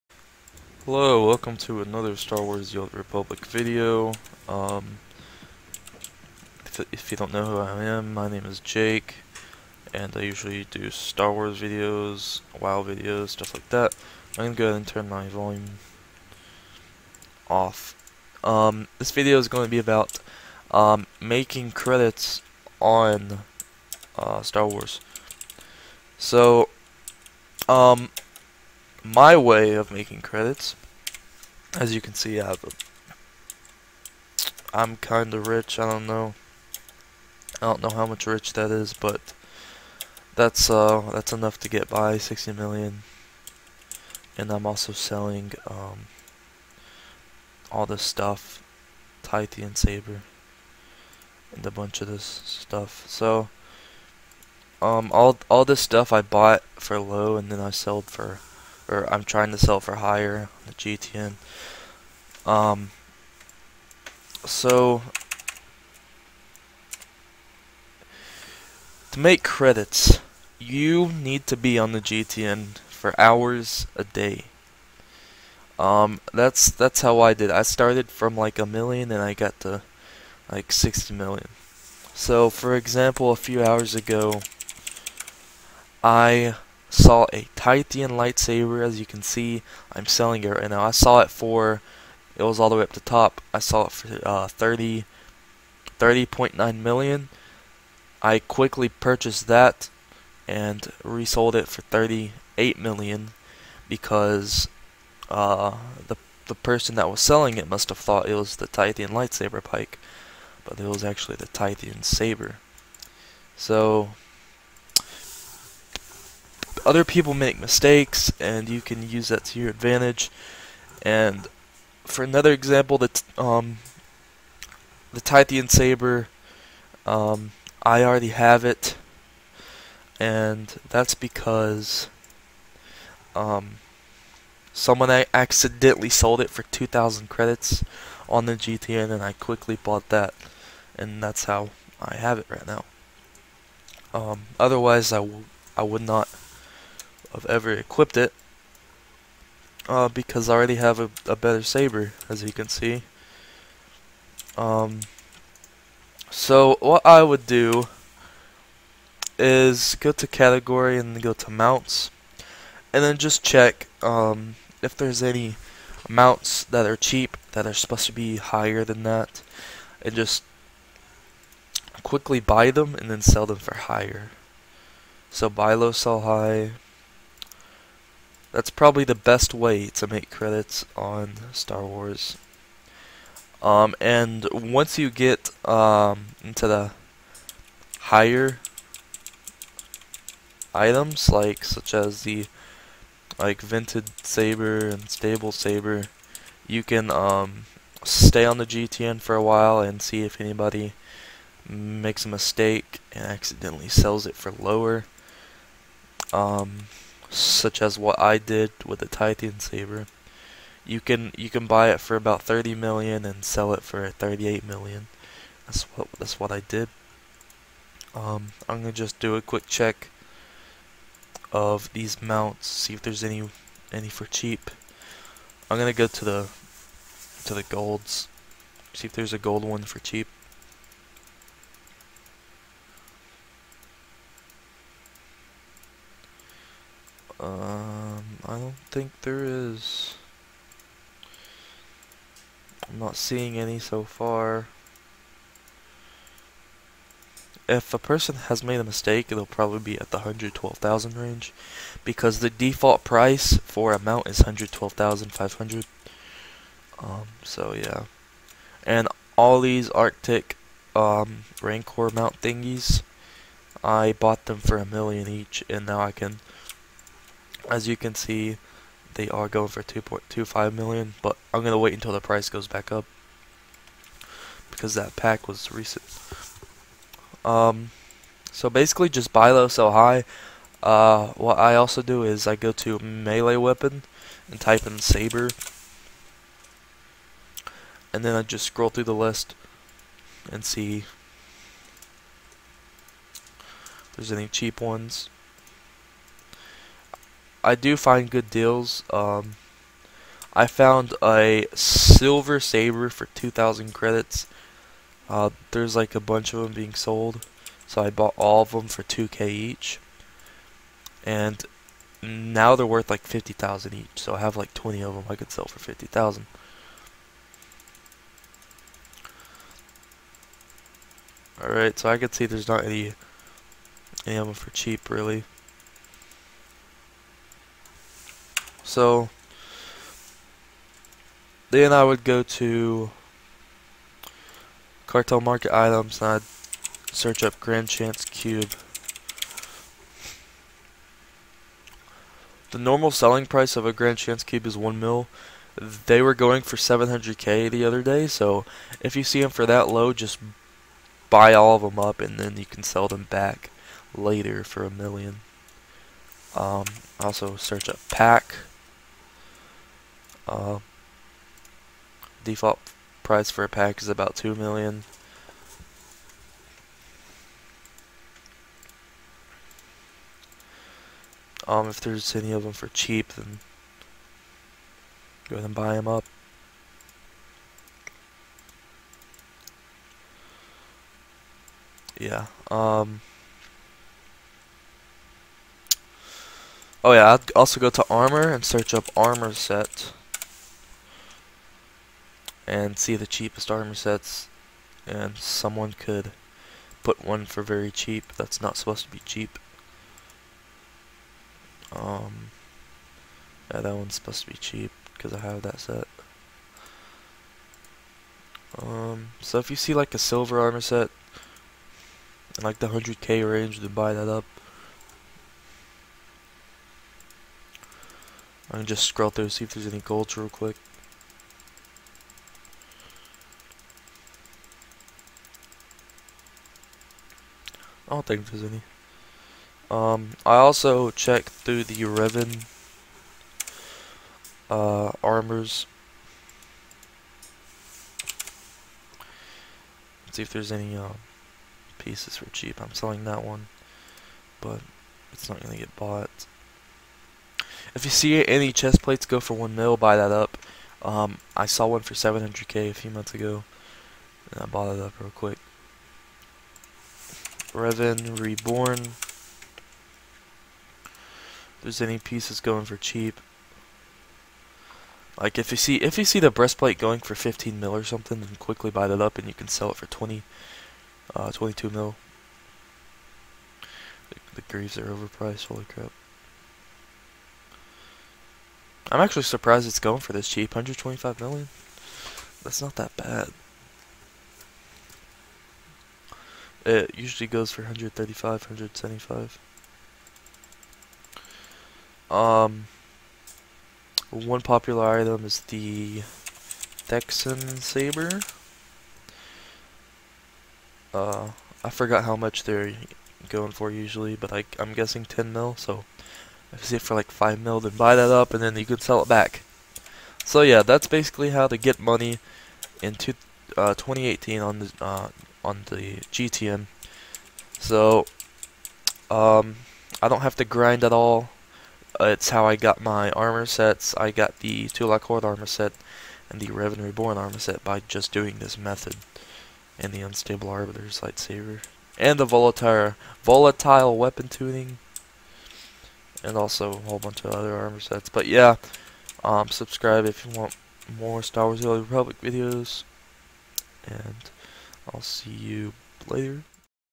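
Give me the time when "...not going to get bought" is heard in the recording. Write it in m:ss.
7:25.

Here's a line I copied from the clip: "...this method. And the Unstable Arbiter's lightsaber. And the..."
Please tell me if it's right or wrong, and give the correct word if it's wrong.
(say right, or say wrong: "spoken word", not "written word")
right.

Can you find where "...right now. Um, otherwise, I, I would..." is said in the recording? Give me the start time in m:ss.
2:22.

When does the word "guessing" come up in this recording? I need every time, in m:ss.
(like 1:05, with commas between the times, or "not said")
8:24.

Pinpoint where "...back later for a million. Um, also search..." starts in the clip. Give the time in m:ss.
5:53.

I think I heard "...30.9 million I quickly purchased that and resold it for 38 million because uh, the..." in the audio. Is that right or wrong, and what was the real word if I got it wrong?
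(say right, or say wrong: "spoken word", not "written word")
right.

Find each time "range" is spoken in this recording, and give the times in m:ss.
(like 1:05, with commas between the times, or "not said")
4:11, 6:53.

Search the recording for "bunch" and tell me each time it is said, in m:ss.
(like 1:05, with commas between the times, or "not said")
0:51, 5:06, 8:57.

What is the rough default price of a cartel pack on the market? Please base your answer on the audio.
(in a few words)
2 million.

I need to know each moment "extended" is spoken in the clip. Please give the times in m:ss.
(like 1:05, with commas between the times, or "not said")
not said.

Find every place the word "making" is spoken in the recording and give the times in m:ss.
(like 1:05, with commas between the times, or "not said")
0:21, 0:29.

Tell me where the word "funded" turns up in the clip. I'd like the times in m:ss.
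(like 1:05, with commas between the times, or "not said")
not said.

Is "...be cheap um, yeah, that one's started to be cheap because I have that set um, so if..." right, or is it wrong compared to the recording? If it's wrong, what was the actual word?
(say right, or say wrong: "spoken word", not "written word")
wrong: "supposed", not "started".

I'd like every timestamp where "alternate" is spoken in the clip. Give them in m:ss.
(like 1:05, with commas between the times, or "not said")
not said.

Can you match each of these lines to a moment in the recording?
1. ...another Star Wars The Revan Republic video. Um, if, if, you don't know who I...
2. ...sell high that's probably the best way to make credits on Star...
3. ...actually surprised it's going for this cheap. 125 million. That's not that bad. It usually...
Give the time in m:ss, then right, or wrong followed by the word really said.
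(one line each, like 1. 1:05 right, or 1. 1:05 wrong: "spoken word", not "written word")
1. 0:01 wrong: "Old", not "Revan"
2. 2:55 right
3. 7:59 right.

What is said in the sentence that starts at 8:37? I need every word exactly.
So, um, I don't have to grind at all.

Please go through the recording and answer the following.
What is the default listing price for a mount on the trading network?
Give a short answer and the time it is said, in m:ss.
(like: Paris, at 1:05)
112,500, at 4:14.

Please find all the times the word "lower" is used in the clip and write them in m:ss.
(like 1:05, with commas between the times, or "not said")
3:24.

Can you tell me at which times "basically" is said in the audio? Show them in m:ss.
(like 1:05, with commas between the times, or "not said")
4:38, 8:31.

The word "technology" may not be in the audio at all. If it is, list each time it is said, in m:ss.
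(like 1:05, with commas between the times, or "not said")
not said.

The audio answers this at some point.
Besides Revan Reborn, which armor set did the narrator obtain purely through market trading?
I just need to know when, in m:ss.
8:44.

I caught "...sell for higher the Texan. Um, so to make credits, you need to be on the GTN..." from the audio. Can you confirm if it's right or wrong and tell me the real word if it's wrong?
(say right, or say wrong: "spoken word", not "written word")
wrong: "GTN", not "Texan".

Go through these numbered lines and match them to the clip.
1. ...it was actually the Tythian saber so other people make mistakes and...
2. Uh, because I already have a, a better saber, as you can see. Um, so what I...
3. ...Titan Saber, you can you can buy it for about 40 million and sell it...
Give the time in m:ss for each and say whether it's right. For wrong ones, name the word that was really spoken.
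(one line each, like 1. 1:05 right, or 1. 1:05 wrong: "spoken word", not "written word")
1. 1:50 right
2. 2:29 right
3. 3:29 wrong: "30", not "40".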